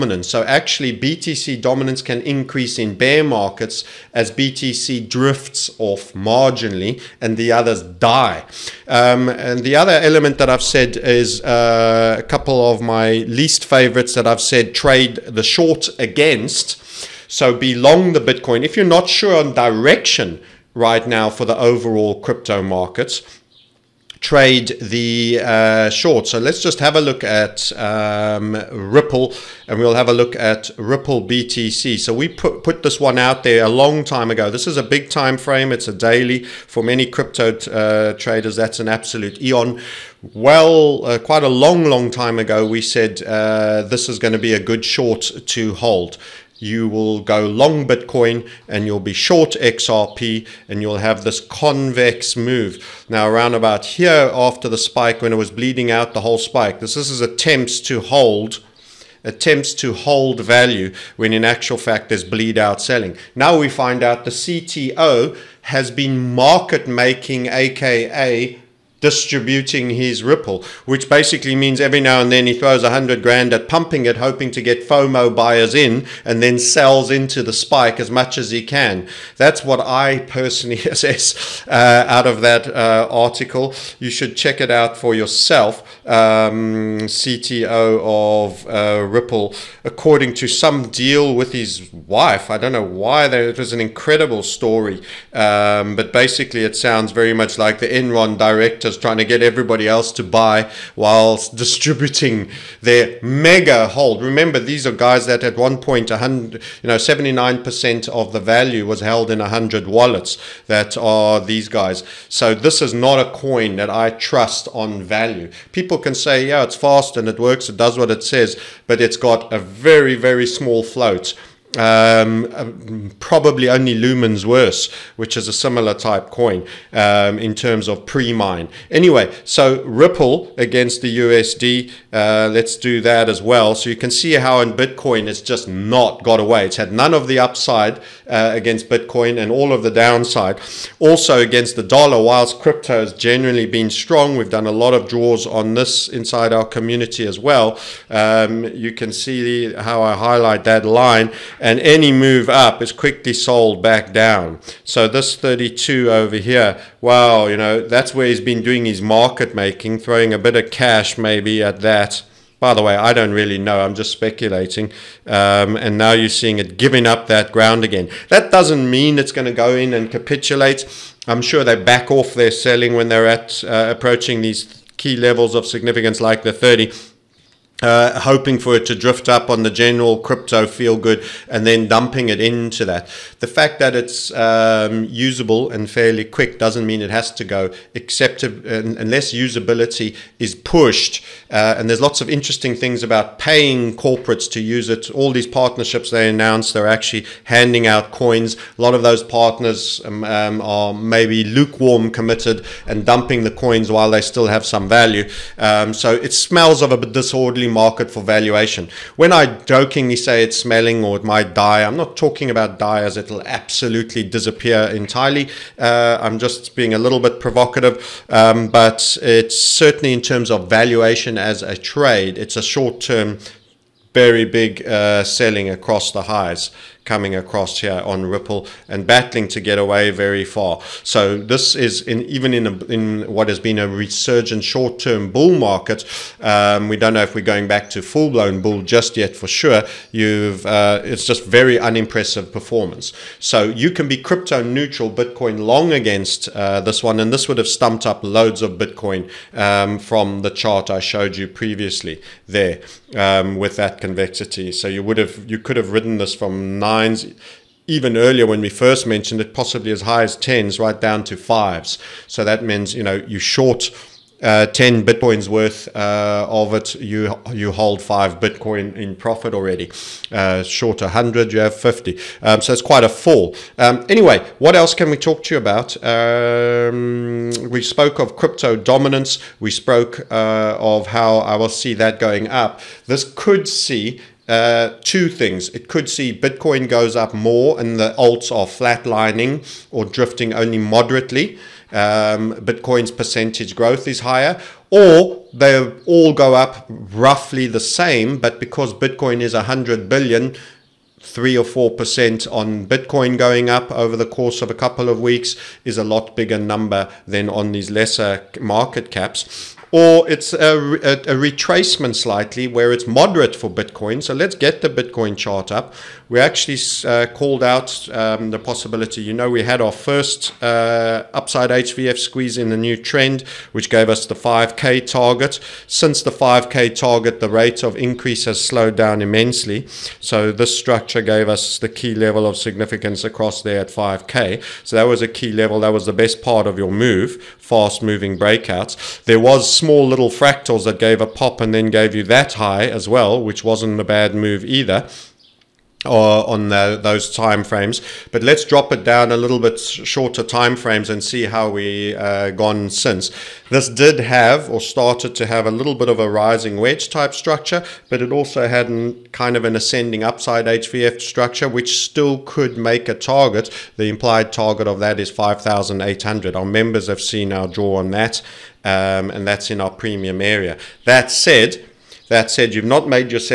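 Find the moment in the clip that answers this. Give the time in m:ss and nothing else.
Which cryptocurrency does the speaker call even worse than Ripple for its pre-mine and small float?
2:03.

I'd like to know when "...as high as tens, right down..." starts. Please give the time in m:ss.
4:19.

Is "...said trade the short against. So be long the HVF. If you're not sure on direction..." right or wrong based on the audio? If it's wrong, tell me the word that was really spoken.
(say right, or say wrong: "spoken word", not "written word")
wrong: "Bitcoin", not "HVF".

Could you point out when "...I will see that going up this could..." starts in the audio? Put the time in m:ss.
4:41.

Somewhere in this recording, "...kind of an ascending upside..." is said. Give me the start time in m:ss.
5:59.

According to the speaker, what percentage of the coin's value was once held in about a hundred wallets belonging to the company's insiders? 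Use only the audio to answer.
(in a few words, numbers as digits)
79%.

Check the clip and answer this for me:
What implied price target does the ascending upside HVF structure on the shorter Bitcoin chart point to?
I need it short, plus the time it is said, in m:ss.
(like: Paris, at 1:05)
5800, at 6:05.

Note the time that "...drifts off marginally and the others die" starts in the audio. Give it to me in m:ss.
0:05.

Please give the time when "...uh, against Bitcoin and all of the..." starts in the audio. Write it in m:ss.
2:18.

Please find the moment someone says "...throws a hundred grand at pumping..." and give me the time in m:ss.
1:12.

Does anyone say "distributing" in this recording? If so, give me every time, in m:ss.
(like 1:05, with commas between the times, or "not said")
1:09, 1:41.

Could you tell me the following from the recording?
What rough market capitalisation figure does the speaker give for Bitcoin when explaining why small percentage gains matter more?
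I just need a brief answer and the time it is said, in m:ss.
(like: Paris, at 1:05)
100 billion, at 4:59.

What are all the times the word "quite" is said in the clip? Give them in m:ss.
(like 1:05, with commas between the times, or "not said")
0:41, 4:32.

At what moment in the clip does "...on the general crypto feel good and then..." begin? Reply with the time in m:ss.
2:59.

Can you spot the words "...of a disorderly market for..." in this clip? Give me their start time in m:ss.
3:26.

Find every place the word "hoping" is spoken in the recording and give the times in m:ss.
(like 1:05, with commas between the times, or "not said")
1:14, 2:58.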